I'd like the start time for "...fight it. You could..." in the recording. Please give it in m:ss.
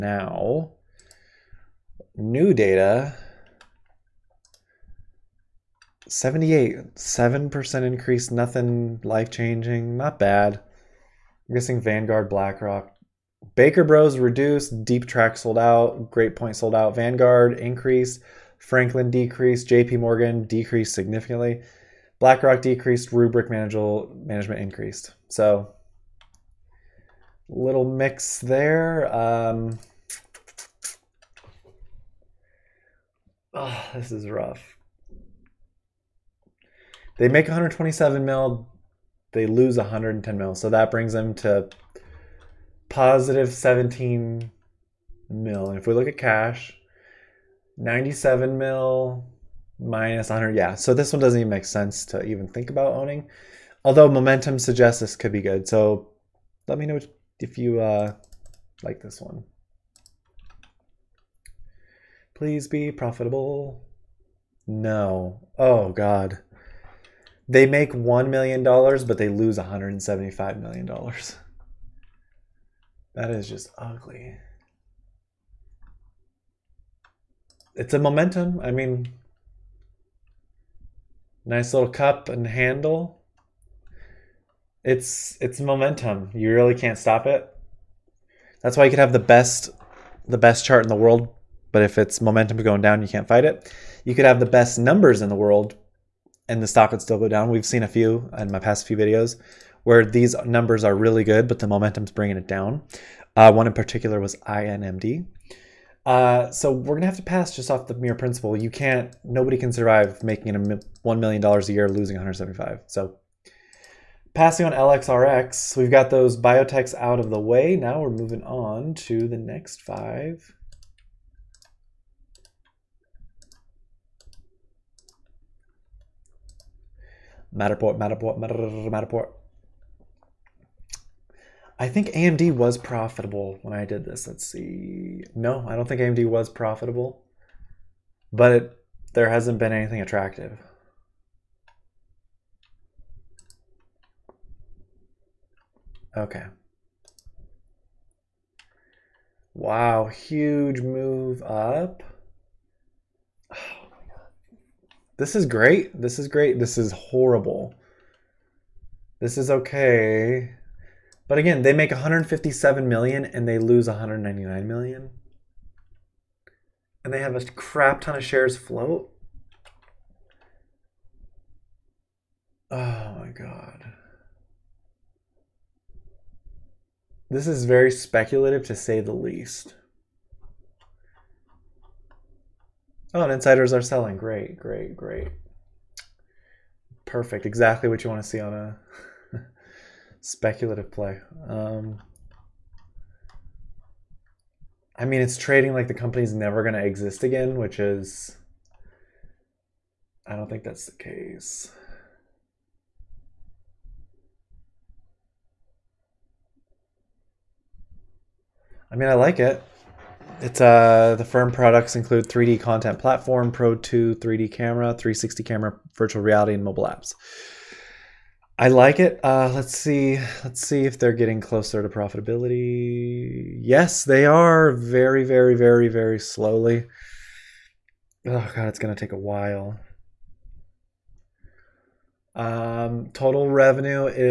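1:33.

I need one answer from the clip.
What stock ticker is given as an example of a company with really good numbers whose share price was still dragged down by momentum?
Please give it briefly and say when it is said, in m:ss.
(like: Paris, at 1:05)
INMD, at 1:44.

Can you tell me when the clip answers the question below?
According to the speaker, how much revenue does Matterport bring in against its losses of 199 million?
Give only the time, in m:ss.
2:41.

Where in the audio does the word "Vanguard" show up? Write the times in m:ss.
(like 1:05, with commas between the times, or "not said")
0:11, 0:16.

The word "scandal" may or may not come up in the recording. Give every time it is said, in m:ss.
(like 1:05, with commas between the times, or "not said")
not said.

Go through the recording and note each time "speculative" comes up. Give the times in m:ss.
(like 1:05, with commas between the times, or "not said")
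2:57, 3:10.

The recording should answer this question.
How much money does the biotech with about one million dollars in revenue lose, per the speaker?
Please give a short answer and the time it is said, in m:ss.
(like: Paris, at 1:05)
$175 million, at 1:09.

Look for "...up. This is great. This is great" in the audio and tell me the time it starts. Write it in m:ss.
2:31.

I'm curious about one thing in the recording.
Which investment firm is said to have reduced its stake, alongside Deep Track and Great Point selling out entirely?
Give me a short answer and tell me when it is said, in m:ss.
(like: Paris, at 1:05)
Baker Bros, at 0:13.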